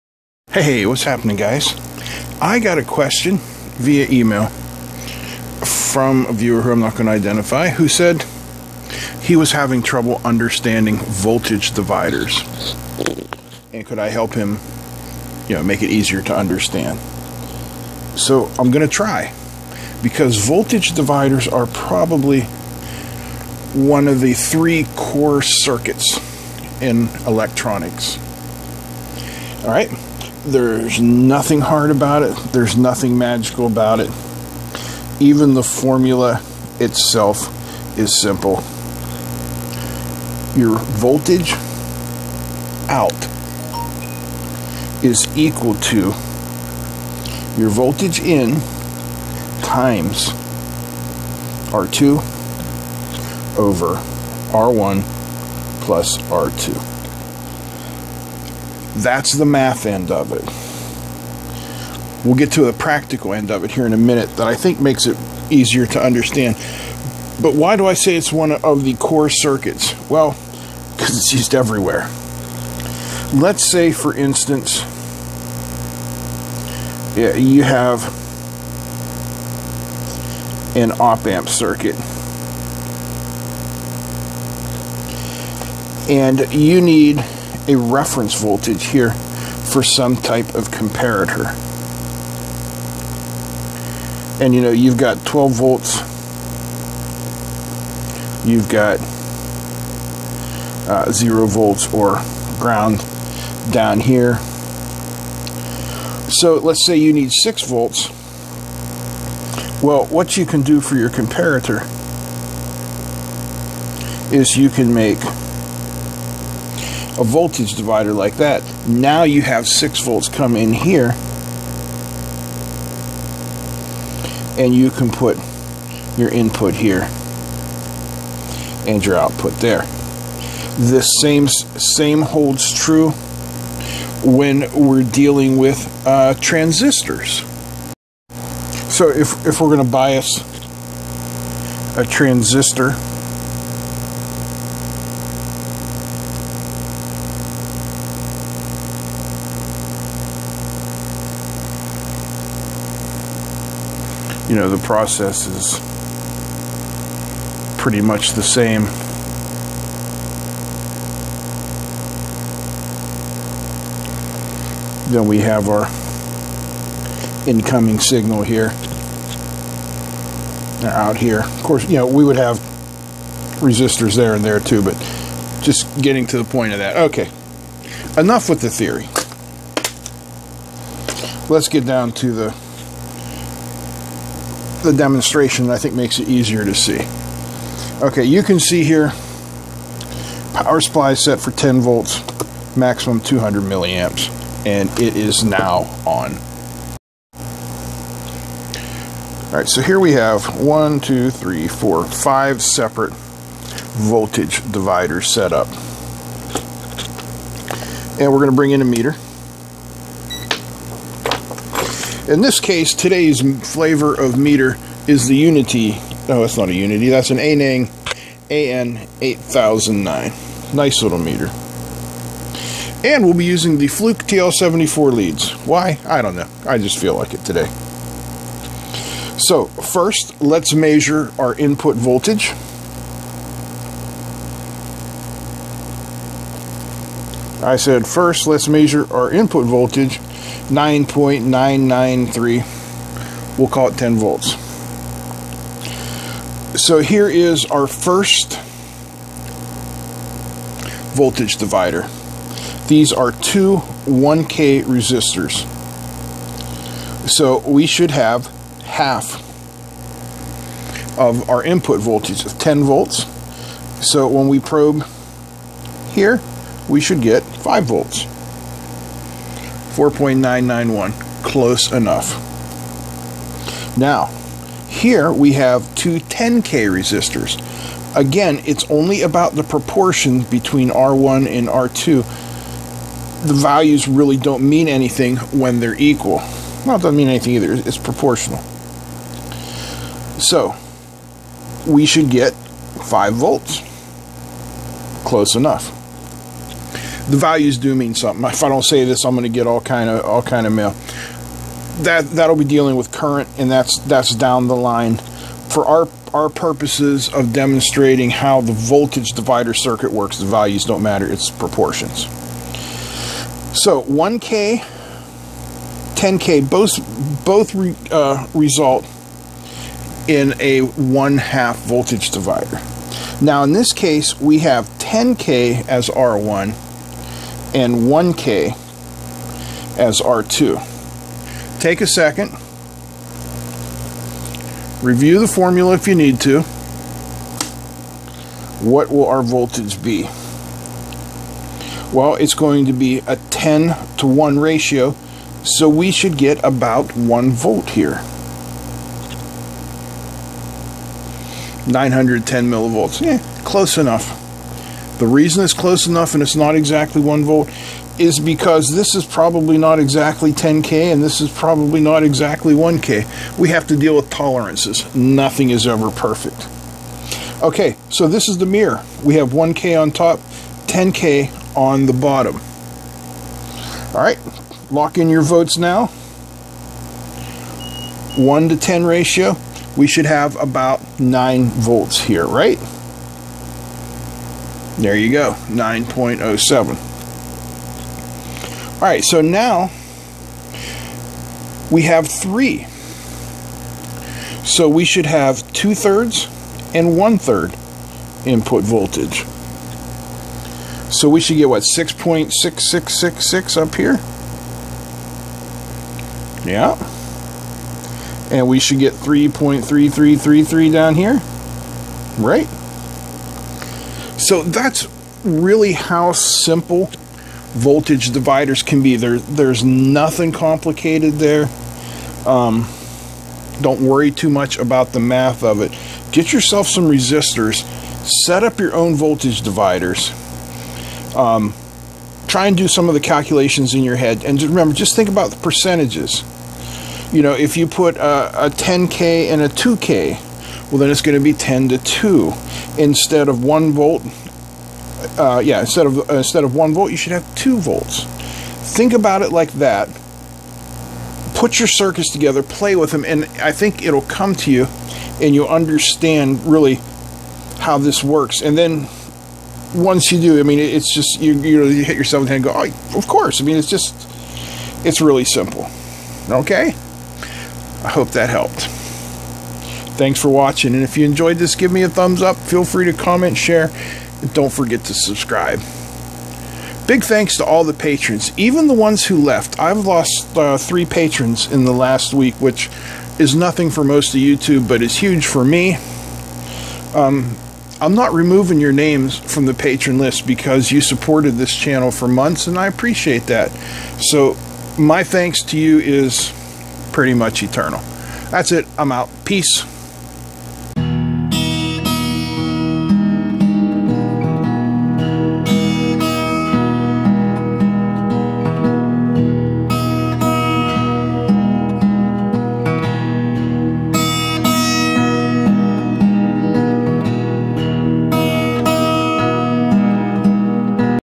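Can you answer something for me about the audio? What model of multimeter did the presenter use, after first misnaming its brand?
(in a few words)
Aneng AN8009.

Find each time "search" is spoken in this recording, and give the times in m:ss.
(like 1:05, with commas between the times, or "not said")
not said.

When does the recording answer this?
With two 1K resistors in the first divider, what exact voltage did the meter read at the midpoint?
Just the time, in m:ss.
4:29.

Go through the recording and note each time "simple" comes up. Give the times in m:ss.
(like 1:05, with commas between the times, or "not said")
0:38, 6:56, 7:45.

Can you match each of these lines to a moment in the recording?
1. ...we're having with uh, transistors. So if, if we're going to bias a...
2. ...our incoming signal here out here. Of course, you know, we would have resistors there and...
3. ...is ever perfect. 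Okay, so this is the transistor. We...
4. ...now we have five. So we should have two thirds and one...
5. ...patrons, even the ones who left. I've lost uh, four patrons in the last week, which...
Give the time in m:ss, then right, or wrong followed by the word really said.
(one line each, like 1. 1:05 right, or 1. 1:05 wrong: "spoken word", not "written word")
1. 2:14 wrong: "dealing", not "having"
2. 2:45 right
3. 6:05 wrong: "mirror", not "transistor"
4. 6:29 wrong: "three", not "five"
5. 7:57 wrong: "three", not "four".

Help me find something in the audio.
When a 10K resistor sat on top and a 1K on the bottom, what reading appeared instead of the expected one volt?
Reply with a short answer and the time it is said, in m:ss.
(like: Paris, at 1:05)
910 millivolts, at 5:51.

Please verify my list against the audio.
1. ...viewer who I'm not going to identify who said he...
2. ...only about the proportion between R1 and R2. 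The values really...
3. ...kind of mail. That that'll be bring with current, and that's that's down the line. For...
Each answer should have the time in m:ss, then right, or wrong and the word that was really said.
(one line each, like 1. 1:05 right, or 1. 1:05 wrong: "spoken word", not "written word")
1. 0:06 right
2. 4:38 right
3. 5:00 wrong: "dealing", not "bring".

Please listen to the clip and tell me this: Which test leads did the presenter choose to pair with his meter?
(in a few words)
Fluke TL74.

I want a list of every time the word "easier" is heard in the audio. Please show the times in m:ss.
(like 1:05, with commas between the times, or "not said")
0:15, 1:05, 3:06.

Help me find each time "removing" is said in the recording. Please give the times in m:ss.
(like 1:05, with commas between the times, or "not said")
8:08.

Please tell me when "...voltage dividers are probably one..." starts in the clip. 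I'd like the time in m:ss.
0:20.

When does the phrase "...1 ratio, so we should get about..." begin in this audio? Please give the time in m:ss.
5:44.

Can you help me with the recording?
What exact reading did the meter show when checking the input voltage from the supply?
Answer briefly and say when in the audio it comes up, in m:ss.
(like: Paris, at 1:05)
9.993, at 4:00.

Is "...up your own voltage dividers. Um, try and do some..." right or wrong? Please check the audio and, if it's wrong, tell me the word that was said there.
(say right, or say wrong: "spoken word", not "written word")
right.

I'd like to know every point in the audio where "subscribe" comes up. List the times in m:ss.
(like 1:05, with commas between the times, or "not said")
7:55.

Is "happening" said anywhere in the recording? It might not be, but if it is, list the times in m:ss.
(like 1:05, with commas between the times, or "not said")
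0:01.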